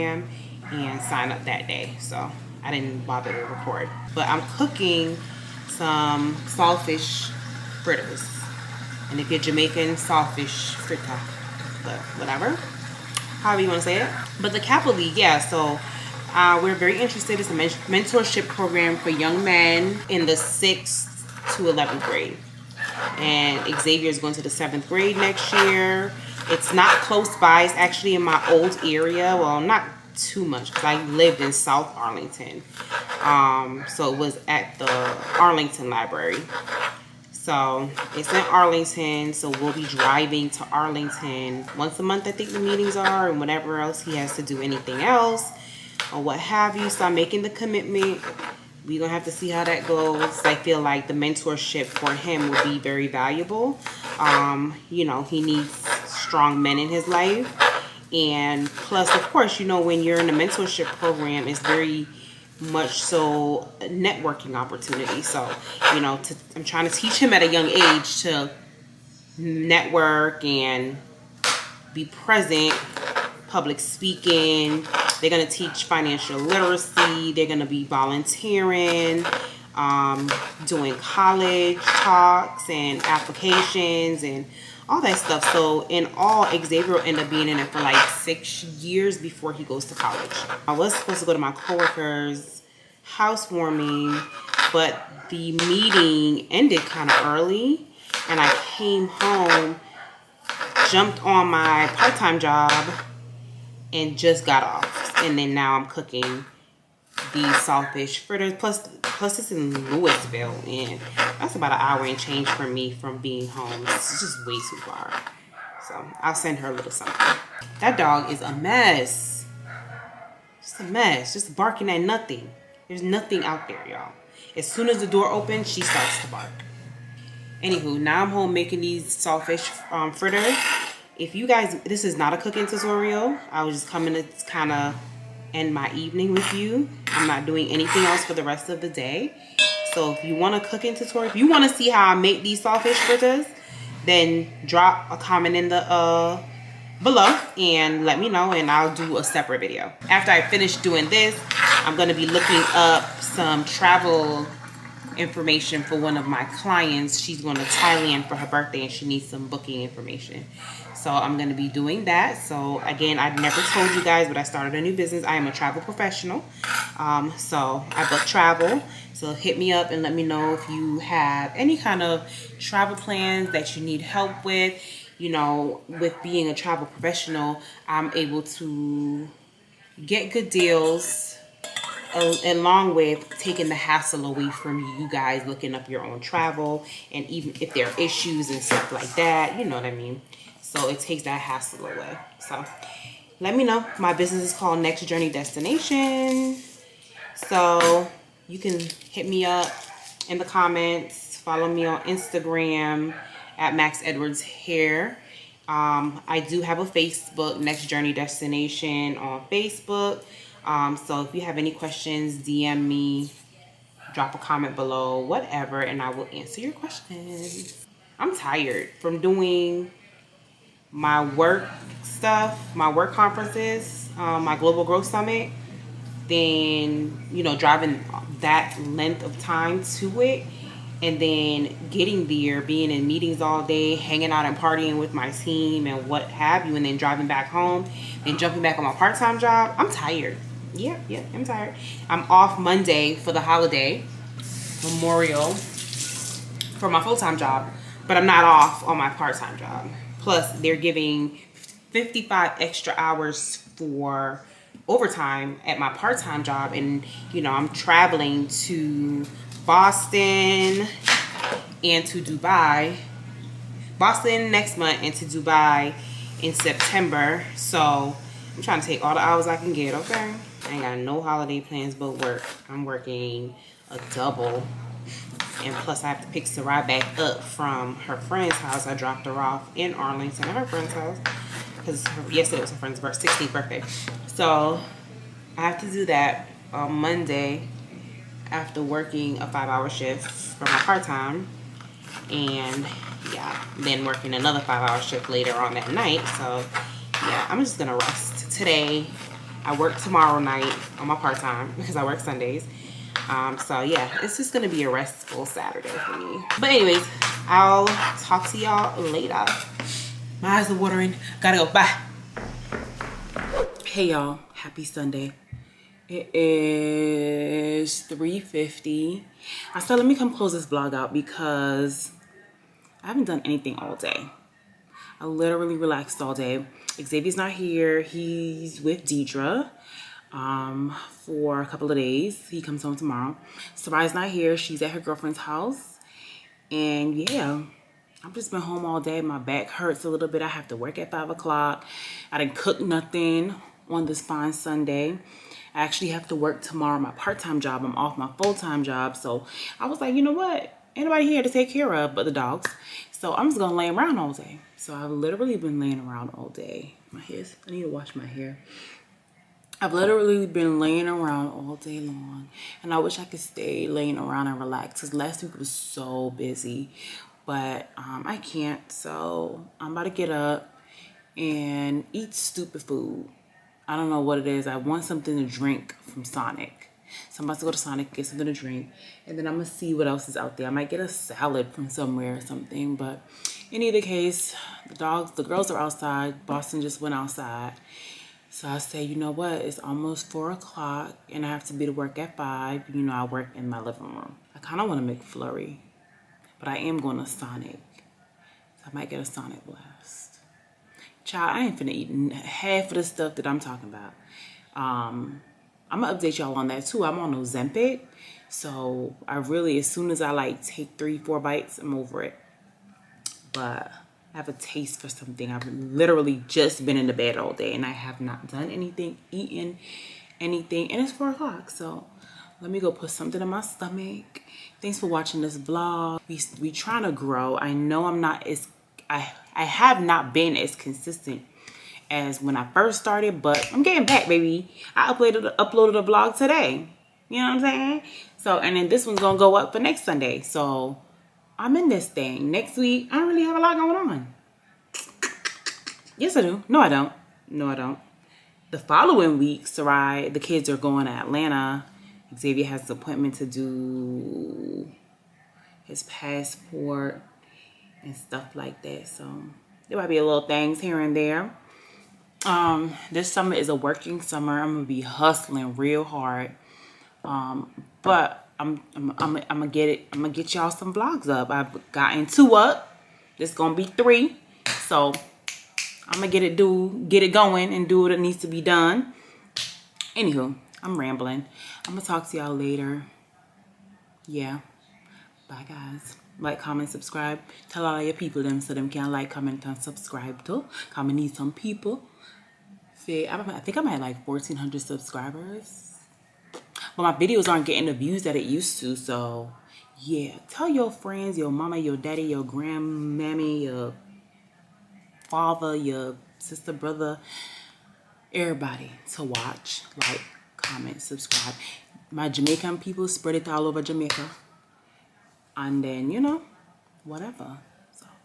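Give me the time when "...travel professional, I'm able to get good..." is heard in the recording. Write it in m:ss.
2:56.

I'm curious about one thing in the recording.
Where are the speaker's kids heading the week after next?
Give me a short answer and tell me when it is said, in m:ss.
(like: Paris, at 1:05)
Atlanta, at 7:31.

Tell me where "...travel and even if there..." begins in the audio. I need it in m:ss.
3:06.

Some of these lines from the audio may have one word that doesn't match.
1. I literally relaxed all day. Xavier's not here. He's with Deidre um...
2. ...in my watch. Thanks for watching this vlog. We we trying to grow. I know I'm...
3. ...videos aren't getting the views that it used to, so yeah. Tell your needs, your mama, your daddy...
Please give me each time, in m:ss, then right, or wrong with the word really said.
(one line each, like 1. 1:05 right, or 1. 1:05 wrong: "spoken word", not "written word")
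1. 5:25 right
2. 7:03 wrong: "stomach", not "watch"
3. 8:17 wrong: "friends", not "needs".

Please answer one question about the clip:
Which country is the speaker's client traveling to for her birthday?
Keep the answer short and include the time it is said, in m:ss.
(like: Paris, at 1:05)
Thailand, at 2:37.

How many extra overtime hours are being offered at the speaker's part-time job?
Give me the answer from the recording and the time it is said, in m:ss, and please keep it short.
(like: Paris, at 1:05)
55, at 4:11.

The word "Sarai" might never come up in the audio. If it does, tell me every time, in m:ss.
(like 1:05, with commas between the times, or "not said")
4:36, 5:33, 7:29.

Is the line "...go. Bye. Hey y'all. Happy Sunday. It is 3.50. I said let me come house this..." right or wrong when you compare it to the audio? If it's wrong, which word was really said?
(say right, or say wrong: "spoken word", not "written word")
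wrong: "close", not "house".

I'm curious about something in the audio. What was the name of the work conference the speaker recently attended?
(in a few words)
Global Growth Summit.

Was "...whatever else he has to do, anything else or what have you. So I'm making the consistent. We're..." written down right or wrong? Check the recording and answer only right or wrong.
wrong.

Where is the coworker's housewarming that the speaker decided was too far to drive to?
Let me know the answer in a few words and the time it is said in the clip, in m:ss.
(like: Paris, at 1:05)
Lewisville, at 1:49.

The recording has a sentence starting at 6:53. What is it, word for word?
But I have a taste for something.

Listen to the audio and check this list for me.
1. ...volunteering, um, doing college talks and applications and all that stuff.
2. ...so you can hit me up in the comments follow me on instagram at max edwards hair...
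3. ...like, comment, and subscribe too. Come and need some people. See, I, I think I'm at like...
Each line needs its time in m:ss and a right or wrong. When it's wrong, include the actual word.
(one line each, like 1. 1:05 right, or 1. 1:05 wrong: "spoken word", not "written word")
1. 1:17 right
2. 3:17 right
3. 8:09 right.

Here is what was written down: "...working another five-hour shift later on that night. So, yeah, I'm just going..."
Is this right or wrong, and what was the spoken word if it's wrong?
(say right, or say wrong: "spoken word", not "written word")
right.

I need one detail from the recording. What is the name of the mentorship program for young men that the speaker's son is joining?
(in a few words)
Kappa League.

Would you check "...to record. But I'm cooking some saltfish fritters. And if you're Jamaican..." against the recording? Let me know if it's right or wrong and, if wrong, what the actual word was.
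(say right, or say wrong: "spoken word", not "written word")
right.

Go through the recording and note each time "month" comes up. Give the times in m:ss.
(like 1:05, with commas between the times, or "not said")
0:42, 4:24.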